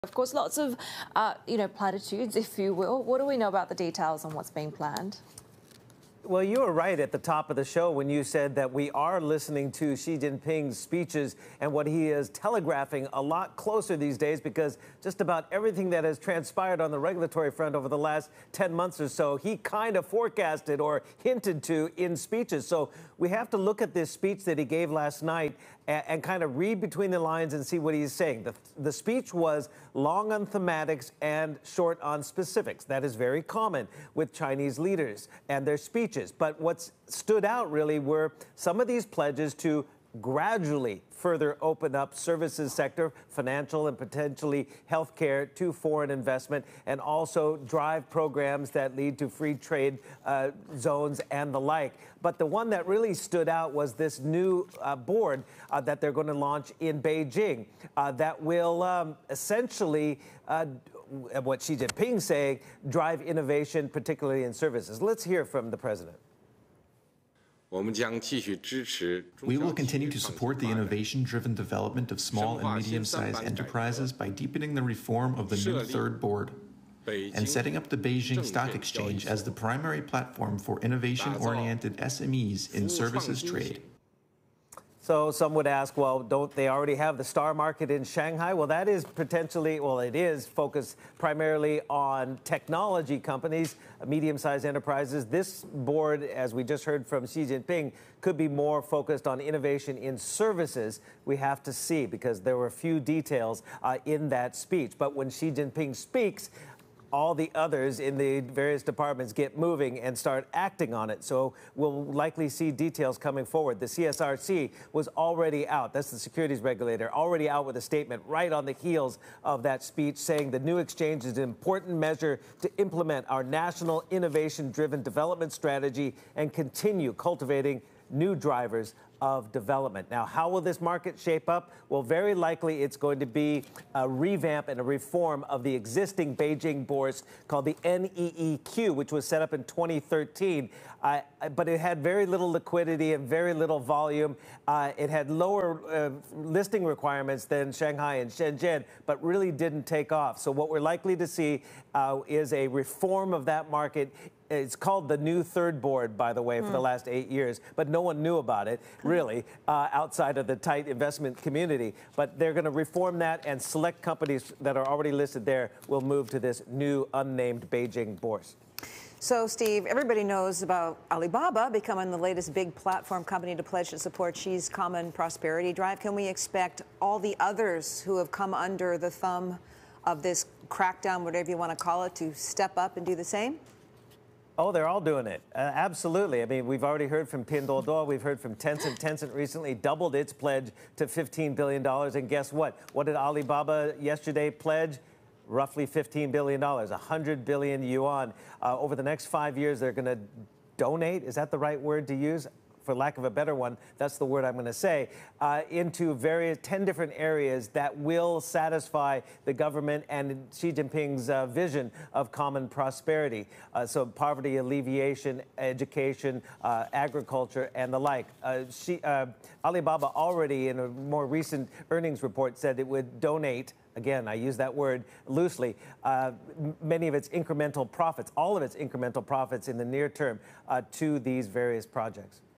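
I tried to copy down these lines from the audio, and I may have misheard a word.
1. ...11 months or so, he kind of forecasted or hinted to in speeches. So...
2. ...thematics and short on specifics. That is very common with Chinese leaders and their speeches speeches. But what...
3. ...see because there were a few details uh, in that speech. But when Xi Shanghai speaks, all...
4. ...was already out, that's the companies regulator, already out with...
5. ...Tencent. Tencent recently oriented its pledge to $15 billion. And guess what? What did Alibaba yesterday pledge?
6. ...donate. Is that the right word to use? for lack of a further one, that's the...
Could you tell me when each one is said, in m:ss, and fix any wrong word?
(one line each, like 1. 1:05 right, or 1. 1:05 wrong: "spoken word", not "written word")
1. 0:18 wrong: "10", not "11"
2. 0:30 right
3. 1:41 wrong: "Jinping", not "Shanghai"
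4. 1:54 wrong: "securities", not "companies"
5. 3:08 wrong: "doubled", not "oriented"
6. 3:20 wrong: "better", not "further".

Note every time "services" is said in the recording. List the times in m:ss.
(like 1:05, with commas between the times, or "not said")
0:42, 1:04, 1:22, 1:40.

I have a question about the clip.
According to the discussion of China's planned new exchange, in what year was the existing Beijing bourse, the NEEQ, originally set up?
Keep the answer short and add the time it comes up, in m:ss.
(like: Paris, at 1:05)
2013, at 2:19.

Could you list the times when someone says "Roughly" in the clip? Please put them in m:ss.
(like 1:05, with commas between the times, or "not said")
3:15.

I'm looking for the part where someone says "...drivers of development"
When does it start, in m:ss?
2:08.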